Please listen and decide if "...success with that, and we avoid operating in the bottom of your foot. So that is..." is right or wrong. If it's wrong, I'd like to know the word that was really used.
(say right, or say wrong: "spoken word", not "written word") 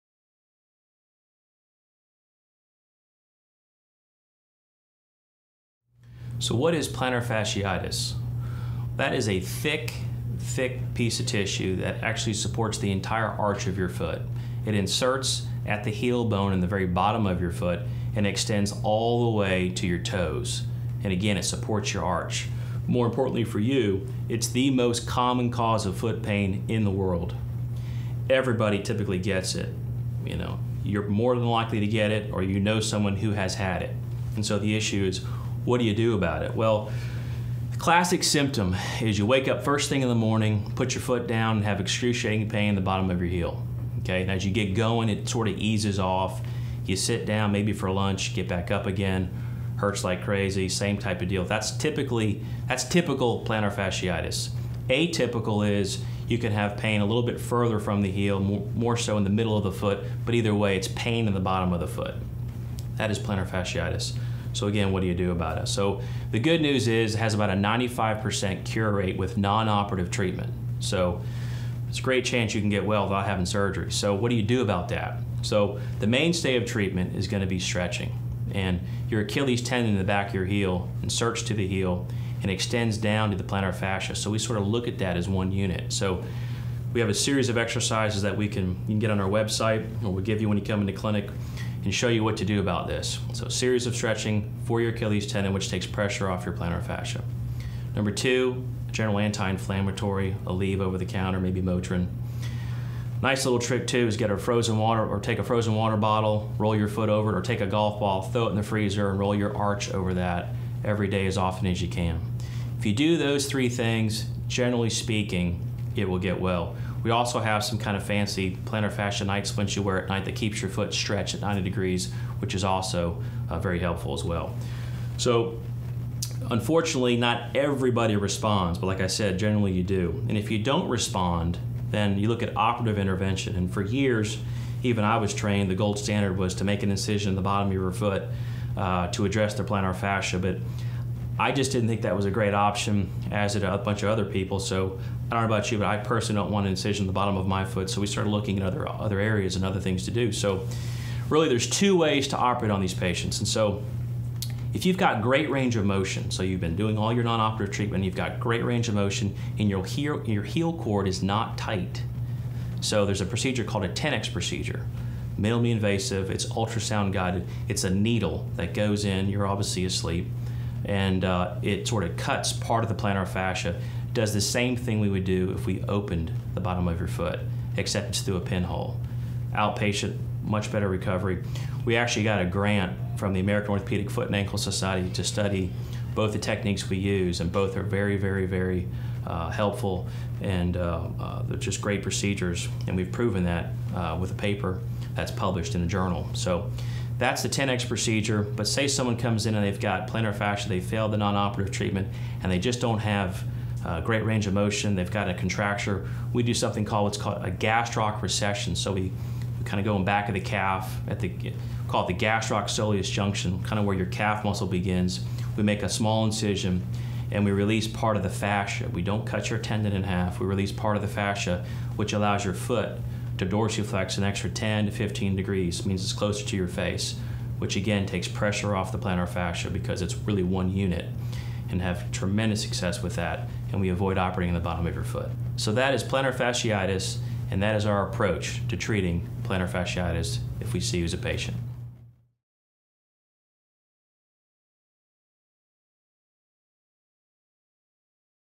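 right.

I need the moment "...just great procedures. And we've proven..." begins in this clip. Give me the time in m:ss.
3:11.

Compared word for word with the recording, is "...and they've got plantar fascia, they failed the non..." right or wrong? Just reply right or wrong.
right.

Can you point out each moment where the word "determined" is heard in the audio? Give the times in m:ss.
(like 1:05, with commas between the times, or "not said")
not said.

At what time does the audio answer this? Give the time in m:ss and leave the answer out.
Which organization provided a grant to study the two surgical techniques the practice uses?
3:03.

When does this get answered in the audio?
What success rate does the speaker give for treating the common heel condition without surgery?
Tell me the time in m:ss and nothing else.
1:07.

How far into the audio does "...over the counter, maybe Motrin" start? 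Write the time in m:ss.
1:40.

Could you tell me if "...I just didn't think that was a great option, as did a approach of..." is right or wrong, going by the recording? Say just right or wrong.
wrong.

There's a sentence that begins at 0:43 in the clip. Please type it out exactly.
Okay, and as you get going, it sort of eases off.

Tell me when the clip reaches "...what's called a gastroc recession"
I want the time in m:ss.
3:27.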